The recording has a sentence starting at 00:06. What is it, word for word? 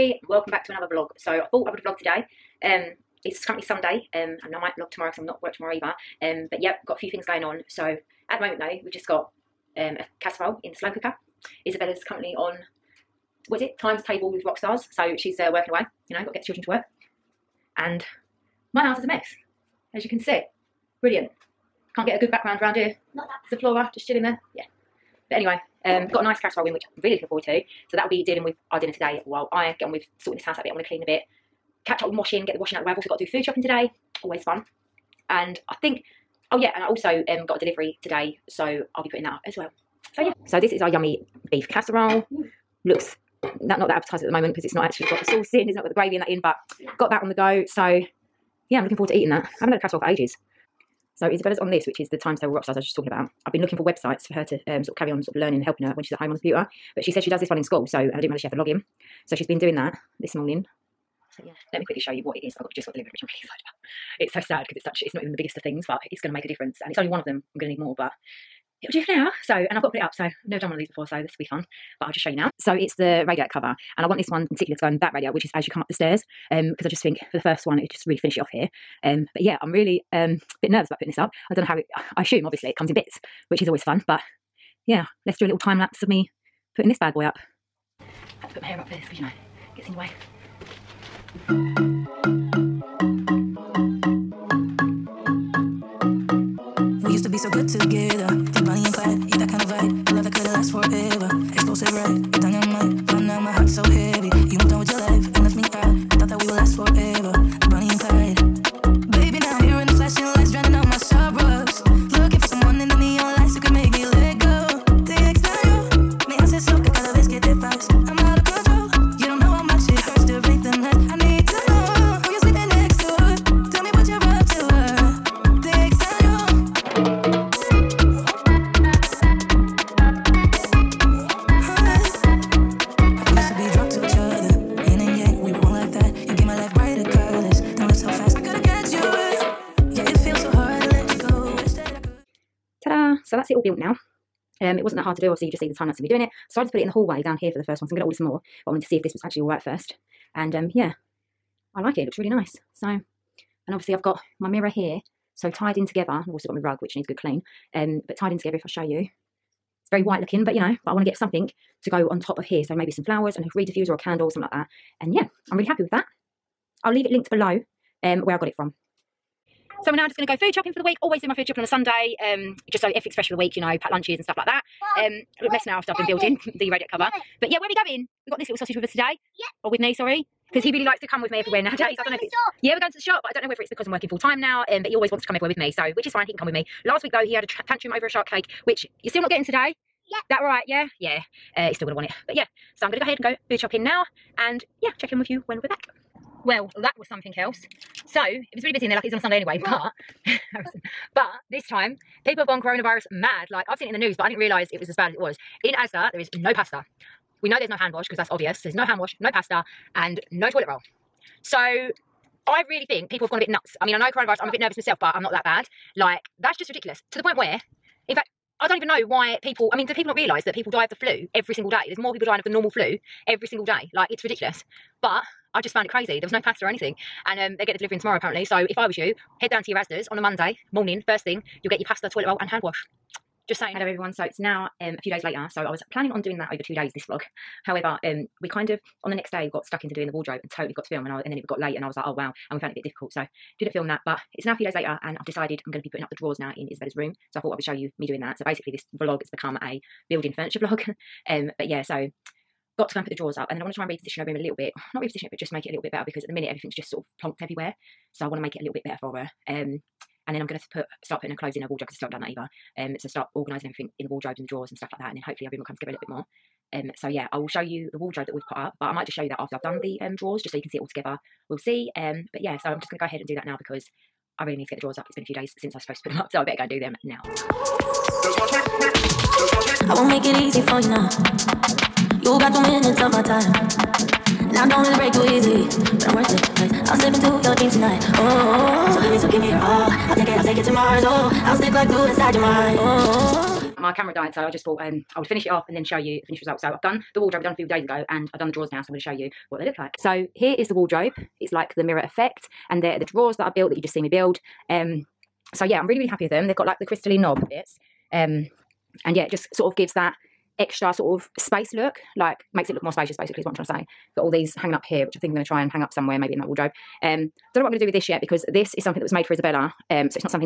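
Um, but yep, got a few things going on.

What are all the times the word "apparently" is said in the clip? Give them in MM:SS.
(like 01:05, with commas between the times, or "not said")
03:48.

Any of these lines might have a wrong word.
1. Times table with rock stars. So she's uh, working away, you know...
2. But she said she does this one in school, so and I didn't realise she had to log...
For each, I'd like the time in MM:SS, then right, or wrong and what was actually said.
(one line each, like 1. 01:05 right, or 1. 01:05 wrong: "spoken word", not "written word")
1. 00:13 right
2. 00:56 right.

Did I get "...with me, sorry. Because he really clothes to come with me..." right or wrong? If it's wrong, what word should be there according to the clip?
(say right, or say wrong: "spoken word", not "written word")
wrong: "likes", not "clothes".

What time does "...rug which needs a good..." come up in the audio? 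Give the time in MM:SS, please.
02:36.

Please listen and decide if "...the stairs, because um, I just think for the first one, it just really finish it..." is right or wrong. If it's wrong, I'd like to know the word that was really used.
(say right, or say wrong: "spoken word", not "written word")
right.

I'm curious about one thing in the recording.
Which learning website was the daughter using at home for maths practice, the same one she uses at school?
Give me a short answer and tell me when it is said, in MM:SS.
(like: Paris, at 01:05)
Times Table Rock Stars, at 00:52.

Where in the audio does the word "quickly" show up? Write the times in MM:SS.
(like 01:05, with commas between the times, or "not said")
01:01.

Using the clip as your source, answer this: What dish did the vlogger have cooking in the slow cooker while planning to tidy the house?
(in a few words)
beef casserole.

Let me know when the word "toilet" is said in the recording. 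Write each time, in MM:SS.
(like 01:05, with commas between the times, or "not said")
03:30, 03:52.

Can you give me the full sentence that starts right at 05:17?
Um, don't know what I'm going to do with this yet because this is something that was made for Isabella.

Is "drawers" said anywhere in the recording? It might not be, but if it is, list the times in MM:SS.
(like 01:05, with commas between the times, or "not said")
04:06, 04:13, 04:24, 04:30, 04:34, 04:58, 05:03.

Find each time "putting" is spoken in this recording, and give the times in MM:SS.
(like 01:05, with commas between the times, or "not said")
00:39, 01:20, 01:26, 04:05, 04:21.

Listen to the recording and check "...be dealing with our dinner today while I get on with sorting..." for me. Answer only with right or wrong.
right.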